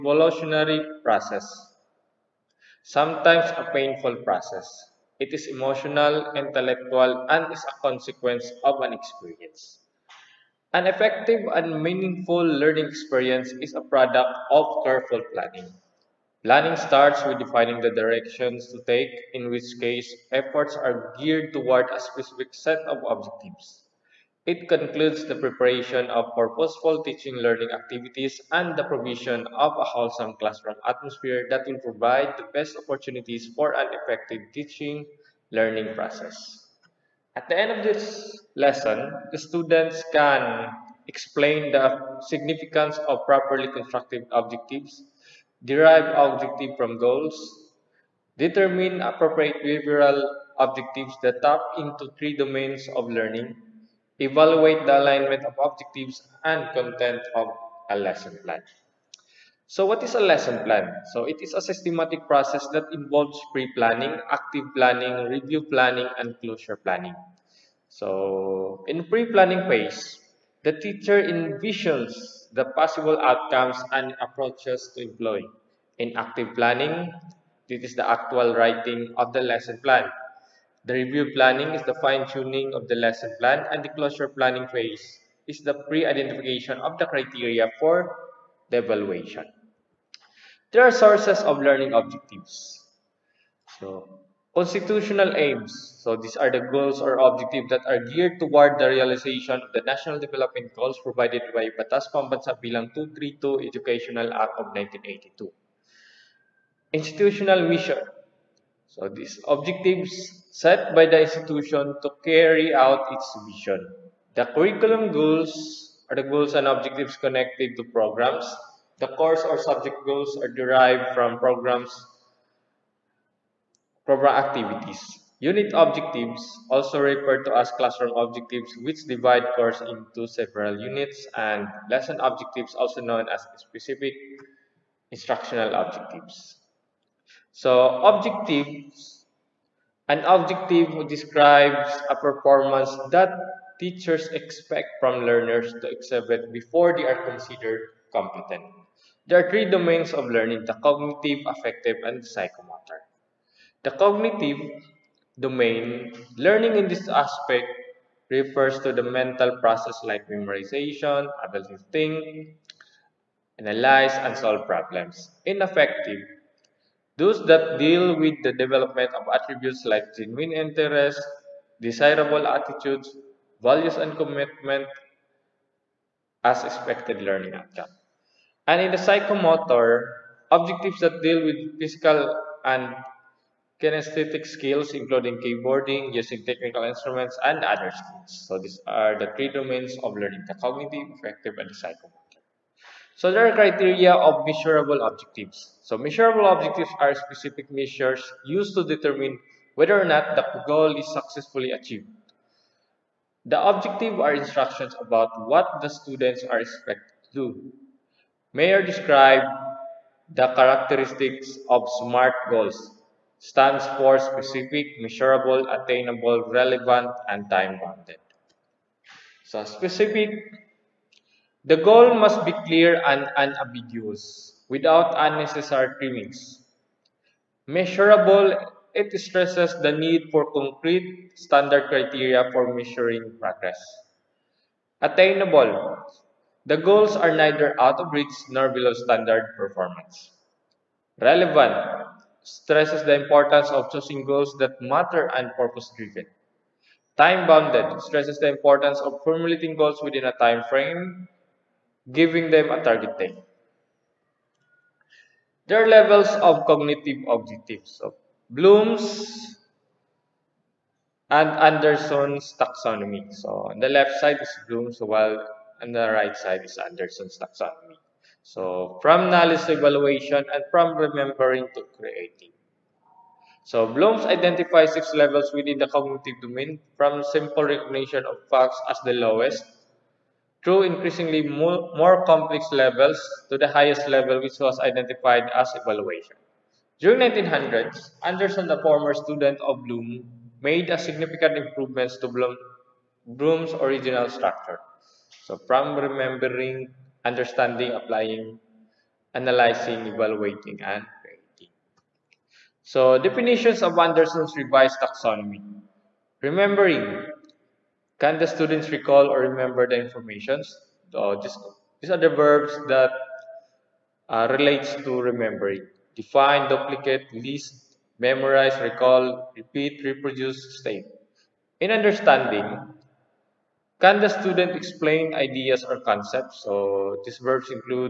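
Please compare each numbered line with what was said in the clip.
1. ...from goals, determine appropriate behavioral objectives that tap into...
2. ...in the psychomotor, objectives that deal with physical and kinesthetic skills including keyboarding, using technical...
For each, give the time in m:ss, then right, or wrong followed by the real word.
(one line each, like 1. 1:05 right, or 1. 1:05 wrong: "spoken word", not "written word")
1. 0:46 right
2. 2:58 right.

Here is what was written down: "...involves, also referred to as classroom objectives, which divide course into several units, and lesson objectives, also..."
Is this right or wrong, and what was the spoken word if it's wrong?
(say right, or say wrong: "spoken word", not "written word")
wrong: "objectives", not "involves".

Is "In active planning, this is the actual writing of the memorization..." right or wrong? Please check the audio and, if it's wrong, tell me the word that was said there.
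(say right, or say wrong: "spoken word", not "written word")
wrong: "lesson", not "memorization".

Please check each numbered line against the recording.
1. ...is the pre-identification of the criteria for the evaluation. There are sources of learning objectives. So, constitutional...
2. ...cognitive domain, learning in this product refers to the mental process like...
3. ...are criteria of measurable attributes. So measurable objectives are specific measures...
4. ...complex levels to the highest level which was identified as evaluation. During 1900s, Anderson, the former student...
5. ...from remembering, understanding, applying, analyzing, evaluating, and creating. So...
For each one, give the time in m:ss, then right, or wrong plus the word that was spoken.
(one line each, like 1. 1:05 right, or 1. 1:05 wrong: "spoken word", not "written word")
1. 1:25 right
2. 2:33 wrong: "aspect", not "product"
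3. 3:13 wrong: "objectives", not "attributes"
4. 4:42 right
5. 4:55 right.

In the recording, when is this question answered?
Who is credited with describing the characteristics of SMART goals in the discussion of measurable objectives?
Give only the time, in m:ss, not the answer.
3:28.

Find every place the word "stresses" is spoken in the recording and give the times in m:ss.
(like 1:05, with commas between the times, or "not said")
3:49, 4:02, 4:08.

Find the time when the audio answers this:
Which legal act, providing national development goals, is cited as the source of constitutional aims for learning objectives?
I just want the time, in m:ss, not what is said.
1:41.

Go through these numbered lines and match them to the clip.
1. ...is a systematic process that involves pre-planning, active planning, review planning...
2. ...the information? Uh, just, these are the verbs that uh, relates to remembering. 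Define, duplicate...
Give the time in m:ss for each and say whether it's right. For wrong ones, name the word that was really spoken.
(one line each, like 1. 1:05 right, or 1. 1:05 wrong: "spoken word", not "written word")
1. 1:01 right
2. 5:09 right.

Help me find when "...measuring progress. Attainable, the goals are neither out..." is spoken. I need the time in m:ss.
3:52.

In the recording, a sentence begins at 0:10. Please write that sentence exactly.
An effective and meaningful learning experience is a product of careful planning.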